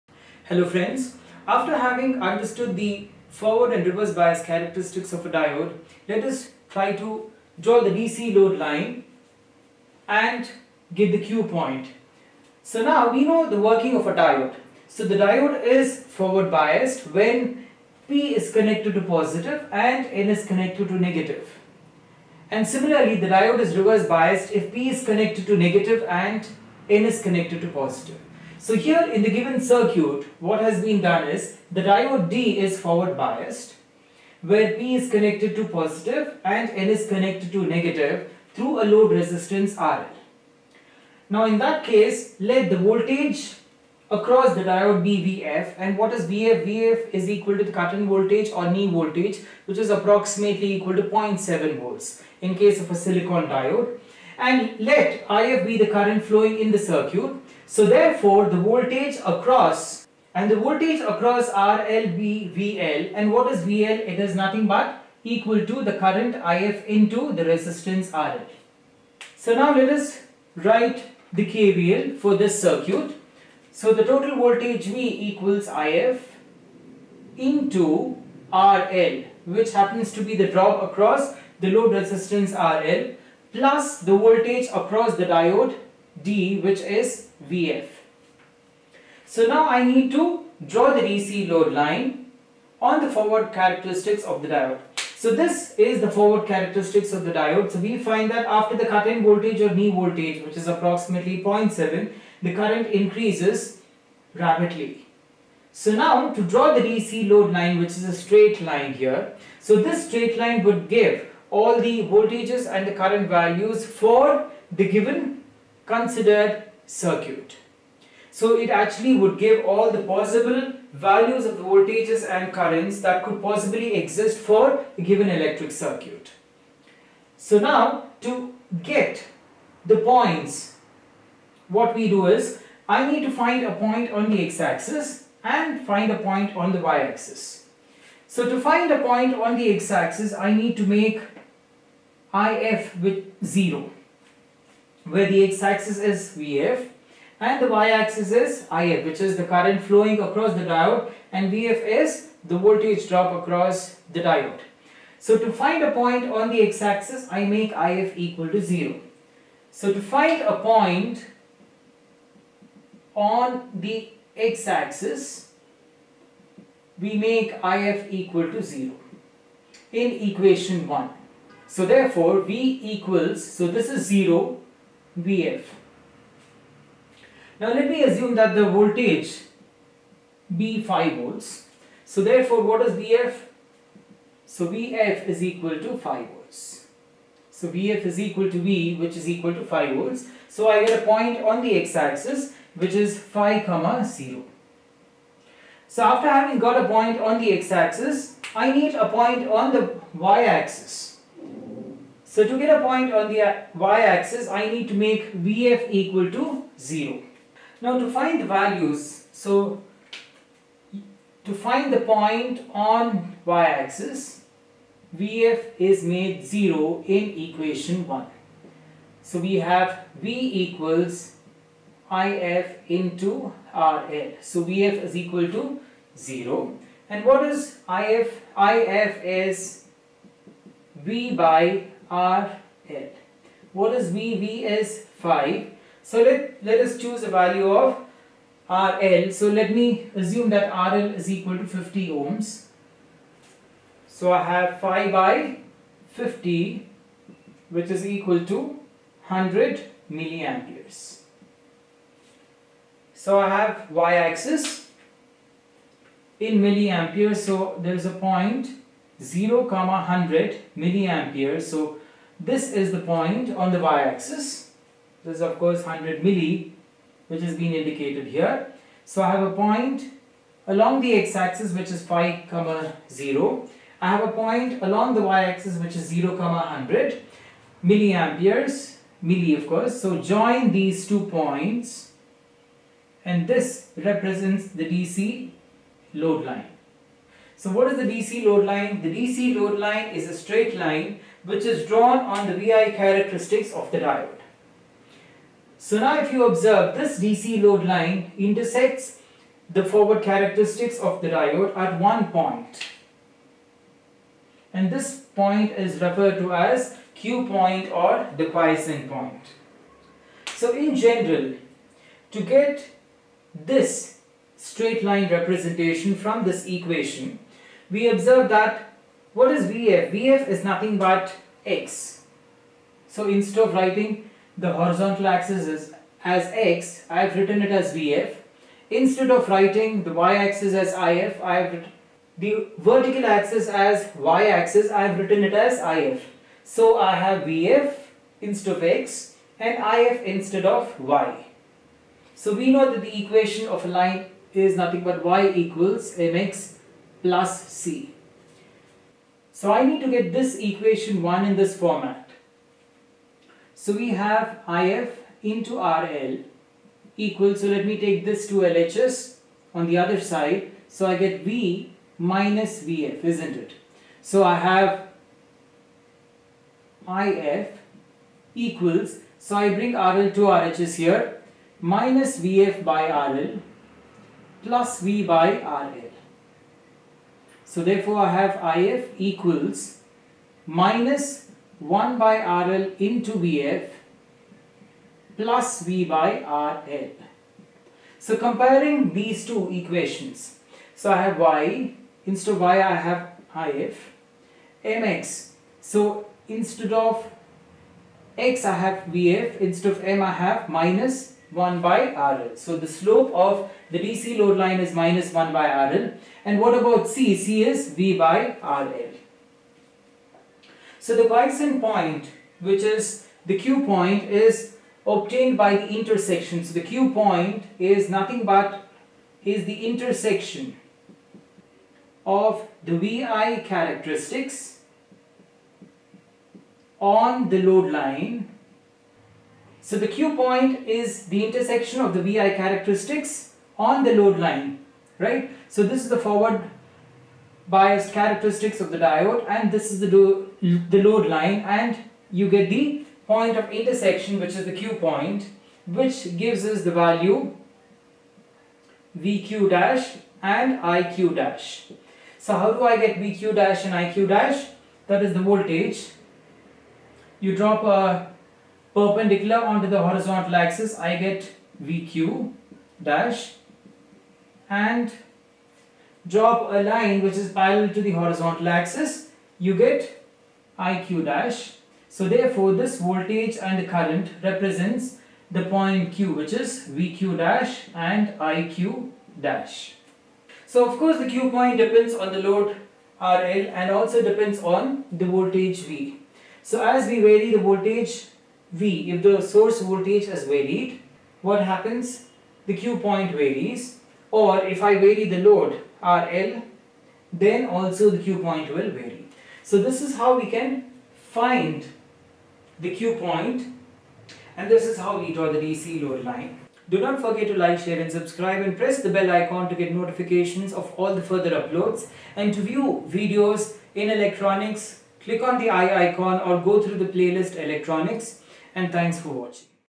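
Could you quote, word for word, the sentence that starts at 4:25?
This is of course 100 milli which has been indicated here.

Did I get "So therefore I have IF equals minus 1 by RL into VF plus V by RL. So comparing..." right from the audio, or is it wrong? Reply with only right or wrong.
right.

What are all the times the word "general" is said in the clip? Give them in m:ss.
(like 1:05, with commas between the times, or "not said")
5:10.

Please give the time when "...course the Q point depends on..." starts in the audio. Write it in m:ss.
8:00.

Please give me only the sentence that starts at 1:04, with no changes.
It is nothing but equal to the current IF into the resistance RL.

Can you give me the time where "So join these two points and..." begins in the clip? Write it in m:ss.
4:40.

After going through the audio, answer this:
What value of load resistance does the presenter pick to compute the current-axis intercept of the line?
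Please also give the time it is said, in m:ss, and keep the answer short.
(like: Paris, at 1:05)
50 ohms, at 4:01.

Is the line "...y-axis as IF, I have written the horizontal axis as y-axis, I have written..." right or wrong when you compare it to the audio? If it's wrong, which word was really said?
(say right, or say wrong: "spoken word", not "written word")
wrong: "vertical", not "horizontal".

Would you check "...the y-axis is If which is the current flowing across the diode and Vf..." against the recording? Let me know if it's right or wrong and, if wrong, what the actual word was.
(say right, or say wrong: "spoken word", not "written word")
right.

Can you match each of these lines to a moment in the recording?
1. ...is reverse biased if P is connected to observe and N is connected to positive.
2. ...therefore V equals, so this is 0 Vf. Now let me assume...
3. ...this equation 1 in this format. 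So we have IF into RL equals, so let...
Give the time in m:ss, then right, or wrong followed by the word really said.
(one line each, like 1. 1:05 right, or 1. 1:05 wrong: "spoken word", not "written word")
1. 0:23 wrong: "negative", not "observe"
2. 2:51 right
3. 5:50 right.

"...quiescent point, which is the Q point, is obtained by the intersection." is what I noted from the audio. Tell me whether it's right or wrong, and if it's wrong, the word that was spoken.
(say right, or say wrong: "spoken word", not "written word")
right.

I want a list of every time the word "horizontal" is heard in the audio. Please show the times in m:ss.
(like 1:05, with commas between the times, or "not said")
5:24, 7:40, 7:48.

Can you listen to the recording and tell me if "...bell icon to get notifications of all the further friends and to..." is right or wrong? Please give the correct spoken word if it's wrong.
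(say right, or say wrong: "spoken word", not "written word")
wrong: "uploads", not "friends".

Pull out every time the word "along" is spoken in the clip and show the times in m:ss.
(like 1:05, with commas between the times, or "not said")
4:30, 4:34.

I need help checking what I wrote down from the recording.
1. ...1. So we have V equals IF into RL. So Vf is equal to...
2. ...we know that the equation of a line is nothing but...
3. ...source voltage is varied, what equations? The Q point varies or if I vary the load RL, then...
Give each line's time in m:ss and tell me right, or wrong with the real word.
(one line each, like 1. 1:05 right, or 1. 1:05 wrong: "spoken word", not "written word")
1. 3:38 right
2. 5:42 right
3. 8:09 wrong: "happens", not "equations".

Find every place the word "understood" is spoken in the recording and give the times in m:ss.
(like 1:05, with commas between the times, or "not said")
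0:02.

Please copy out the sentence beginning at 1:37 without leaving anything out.
So we find that after the cut-in voltage or knee voltage which is approximately 0.7 the current increases rapidly.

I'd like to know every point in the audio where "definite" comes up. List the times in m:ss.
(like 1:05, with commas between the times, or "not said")
not said.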